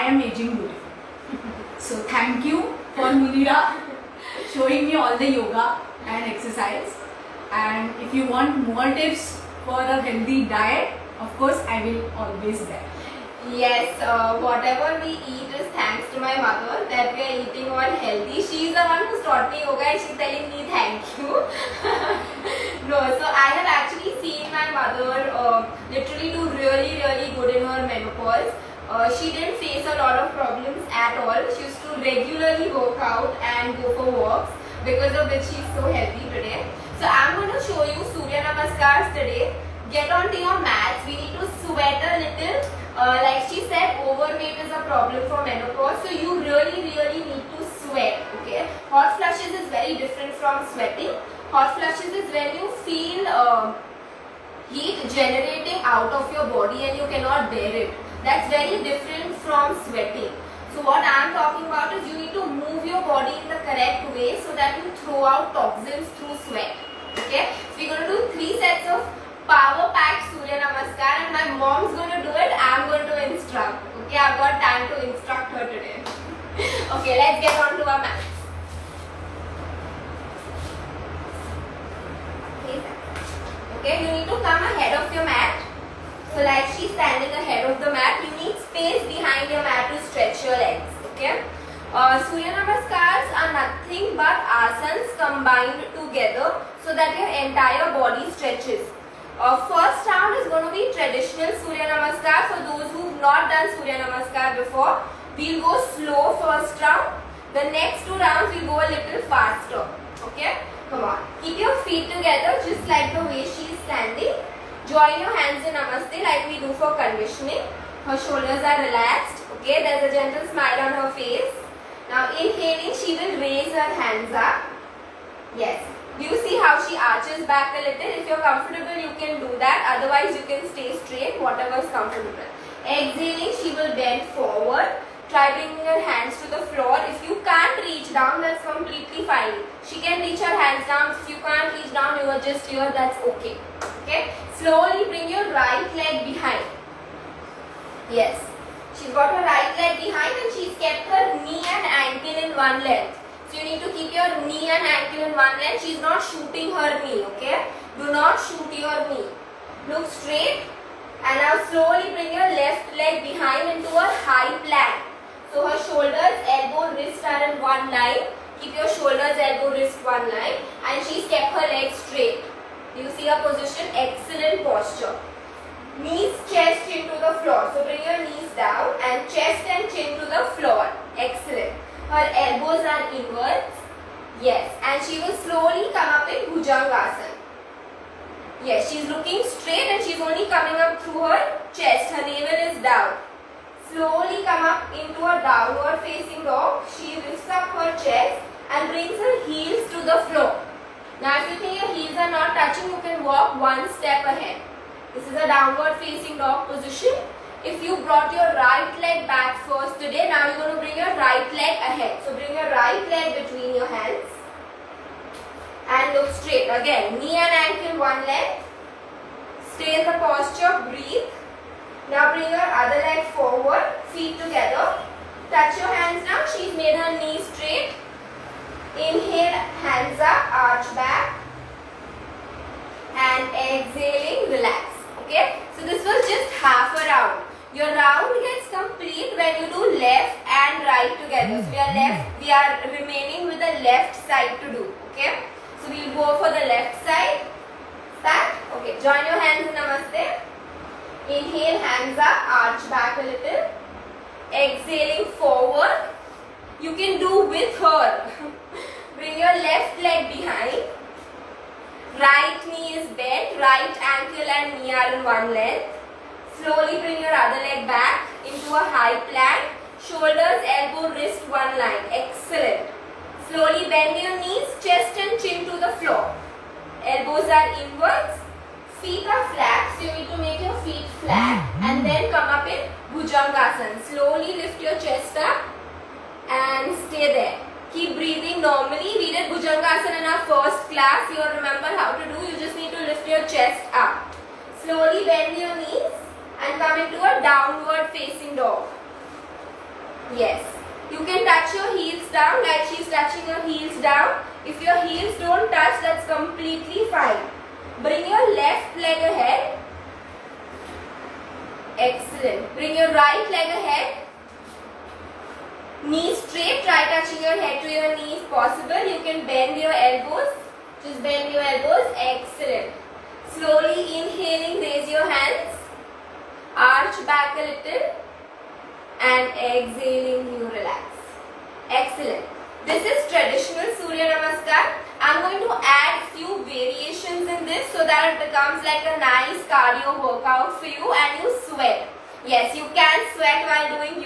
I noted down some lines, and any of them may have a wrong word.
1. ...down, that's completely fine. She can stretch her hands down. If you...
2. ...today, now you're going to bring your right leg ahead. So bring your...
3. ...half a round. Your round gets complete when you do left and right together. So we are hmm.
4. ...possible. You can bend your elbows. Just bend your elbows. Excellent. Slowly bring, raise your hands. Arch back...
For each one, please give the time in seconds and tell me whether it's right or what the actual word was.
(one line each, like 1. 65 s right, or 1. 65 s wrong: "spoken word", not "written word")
1. 138 s wrong: "reach", not "stretch"
2. 209 s right
3. 236 s right
4. 318 s wrong: "inhaling", not "bring".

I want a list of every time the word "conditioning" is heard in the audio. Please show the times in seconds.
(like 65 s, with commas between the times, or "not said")
116 s.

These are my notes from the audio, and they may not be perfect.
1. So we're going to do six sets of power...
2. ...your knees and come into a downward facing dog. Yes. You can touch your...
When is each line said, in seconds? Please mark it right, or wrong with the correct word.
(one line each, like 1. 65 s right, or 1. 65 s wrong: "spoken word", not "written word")
1. 67 s wrong: "three", not "six"
2. 295 s right.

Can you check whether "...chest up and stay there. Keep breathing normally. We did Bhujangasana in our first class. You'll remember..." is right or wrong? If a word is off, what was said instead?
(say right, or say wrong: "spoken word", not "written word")
right.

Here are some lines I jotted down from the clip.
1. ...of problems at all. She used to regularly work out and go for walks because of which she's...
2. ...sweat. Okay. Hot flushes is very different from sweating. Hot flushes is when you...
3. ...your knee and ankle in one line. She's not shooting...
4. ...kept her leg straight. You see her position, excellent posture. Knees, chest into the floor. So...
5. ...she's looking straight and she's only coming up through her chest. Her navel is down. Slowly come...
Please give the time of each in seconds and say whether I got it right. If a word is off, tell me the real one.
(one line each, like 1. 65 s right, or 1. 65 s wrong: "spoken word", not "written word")
1. 30 s right
2. 47 s right
3. 154 s right
4. 171 s right
5. 188 s right.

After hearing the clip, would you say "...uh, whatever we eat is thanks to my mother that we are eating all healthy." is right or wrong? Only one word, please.
right.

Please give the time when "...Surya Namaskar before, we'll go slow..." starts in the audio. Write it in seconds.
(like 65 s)
103 s.